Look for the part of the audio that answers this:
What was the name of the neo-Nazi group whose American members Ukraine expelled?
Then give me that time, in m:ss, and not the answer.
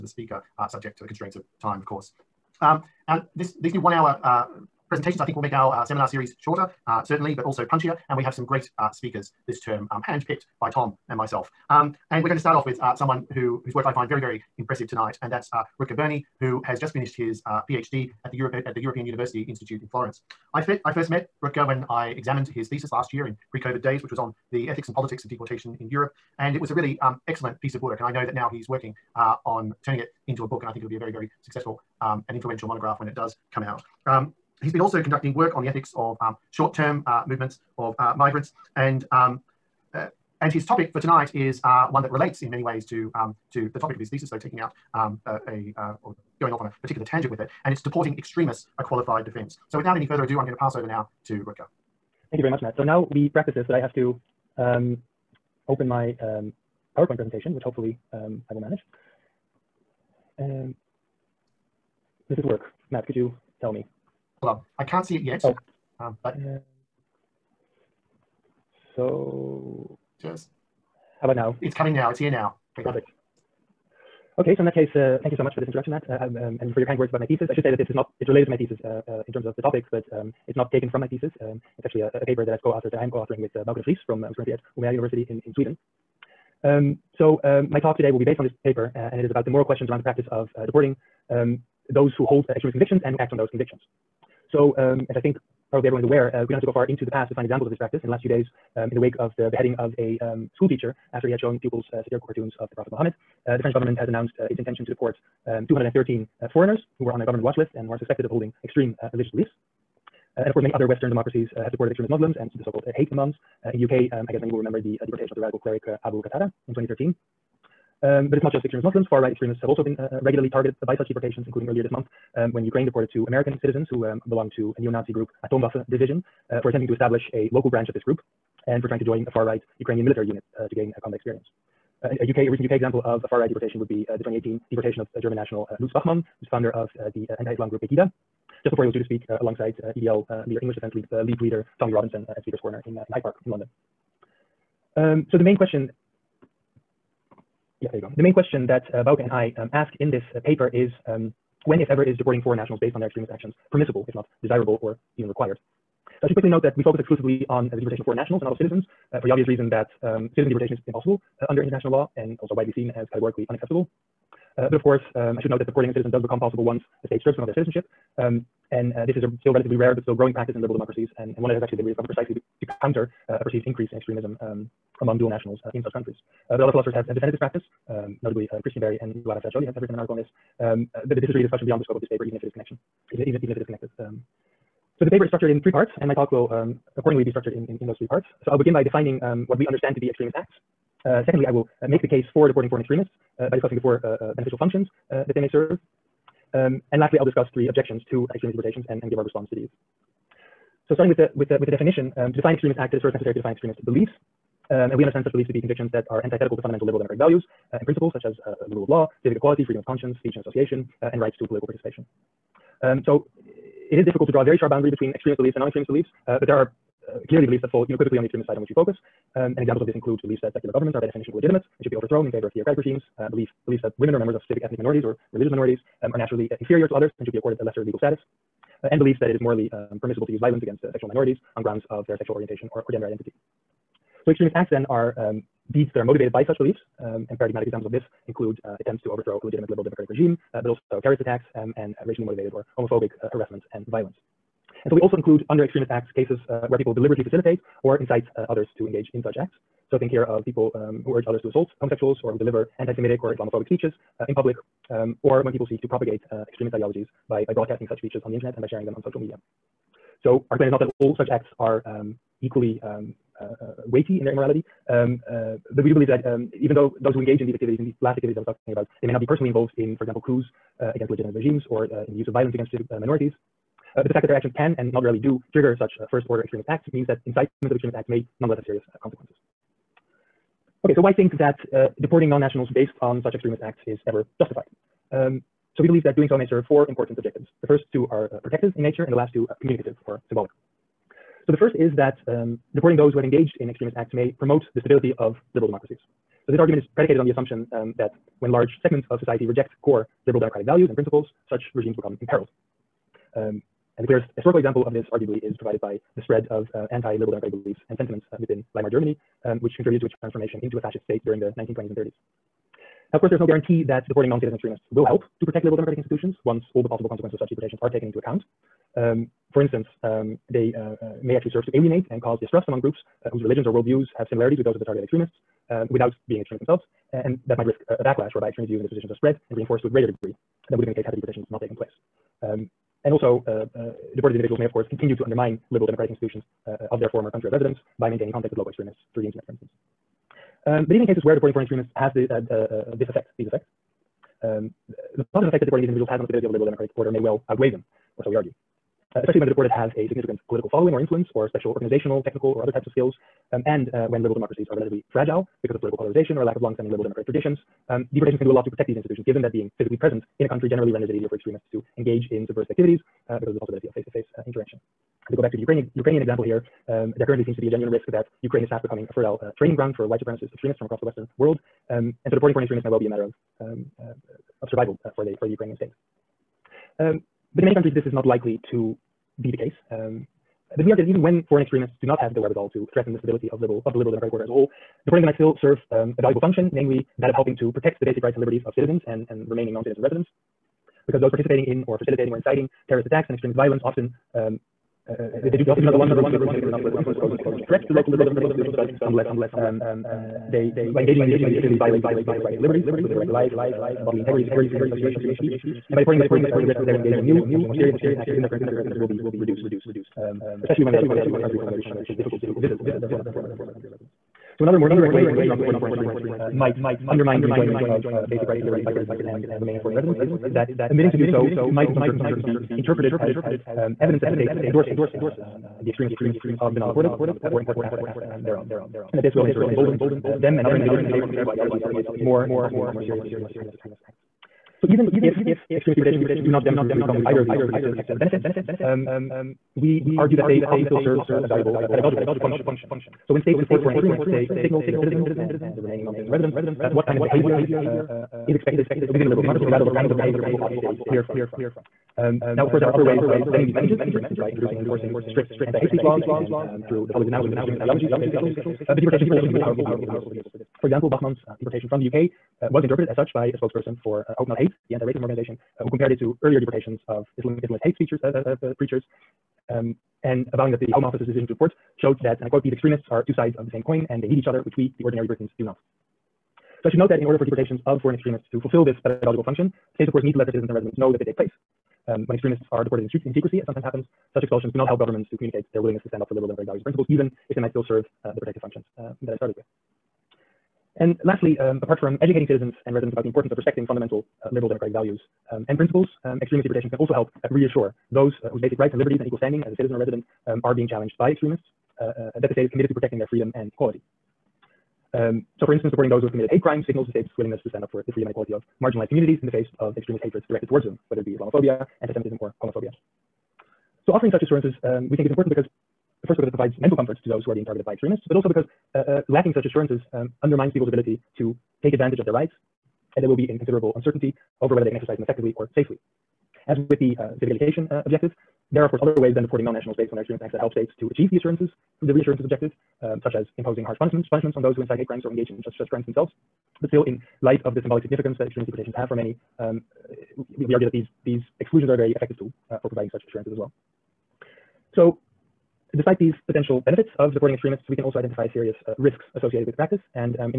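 2:05.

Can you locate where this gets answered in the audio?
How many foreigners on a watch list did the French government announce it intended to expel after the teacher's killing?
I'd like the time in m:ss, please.
1:45.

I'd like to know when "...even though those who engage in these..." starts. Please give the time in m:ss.
4:26.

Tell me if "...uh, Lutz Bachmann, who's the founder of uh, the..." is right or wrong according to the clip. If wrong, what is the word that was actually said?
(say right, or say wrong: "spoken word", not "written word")
right.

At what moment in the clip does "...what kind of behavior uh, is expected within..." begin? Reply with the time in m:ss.
7:26.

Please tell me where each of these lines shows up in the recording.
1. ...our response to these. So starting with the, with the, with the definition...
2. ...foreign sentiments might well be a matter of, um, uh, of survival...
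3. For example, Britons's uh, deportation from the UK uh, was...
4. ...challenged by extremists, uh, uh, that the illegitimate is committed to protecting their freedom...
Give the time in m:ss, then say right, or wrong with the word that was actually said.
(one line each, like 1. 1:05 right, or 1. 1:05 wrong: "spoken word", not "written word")
1. 3:19 right
2. 6:12 wrong: "extremists", not "sentiments"
3. 7:40 wrong: "Bachmann", not "Britons"
4. 8:20 wrong: "state", not "illegitimate".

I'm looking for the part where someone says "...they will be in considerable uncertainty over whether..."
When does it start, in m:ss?
8:43.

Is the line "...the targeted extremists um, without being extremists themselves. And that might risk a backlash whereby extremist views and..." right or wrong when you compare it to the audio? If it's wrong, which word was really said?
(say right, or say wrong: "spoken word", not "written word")
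right.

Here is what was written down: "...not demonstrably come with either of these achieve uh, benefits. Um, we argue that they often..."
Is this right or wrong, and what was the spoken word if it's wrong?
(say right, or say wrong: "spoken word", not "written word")
wrong: "protective", not "achieve".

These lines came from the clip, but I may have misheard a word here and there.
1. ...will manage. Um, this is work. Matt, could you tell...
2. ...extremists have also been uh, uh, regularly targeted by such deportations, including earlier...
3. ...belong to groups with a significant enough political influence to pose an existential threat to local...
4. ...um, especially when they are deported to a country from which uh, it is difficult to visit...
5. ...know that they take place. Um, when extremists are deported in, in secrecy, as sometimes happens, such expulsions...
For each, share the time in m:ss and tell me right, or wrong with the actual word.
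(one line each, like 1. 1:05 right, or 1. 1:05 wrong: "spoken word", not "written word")
1. 0:58 right
2. 1:59 right
3. 6:35 right
4. 6:50 right
5. 8:00 right.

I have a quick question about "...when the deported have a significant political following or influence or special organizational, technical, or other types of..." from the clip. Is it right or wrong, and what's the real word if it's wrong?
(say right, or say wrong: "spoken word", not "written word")
right.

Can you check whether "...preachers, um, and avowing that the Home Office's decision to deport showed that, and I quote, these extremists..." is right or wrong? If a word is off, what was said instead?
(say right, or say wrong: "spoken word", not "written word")
right.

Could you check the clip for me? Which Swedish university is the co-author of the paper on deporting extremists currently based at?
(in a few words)
Umeå University.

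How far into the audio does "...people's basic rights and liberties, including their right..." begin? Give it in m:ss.
6:42.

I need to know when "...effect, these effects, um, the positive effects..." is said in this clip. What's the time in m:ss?
5:43.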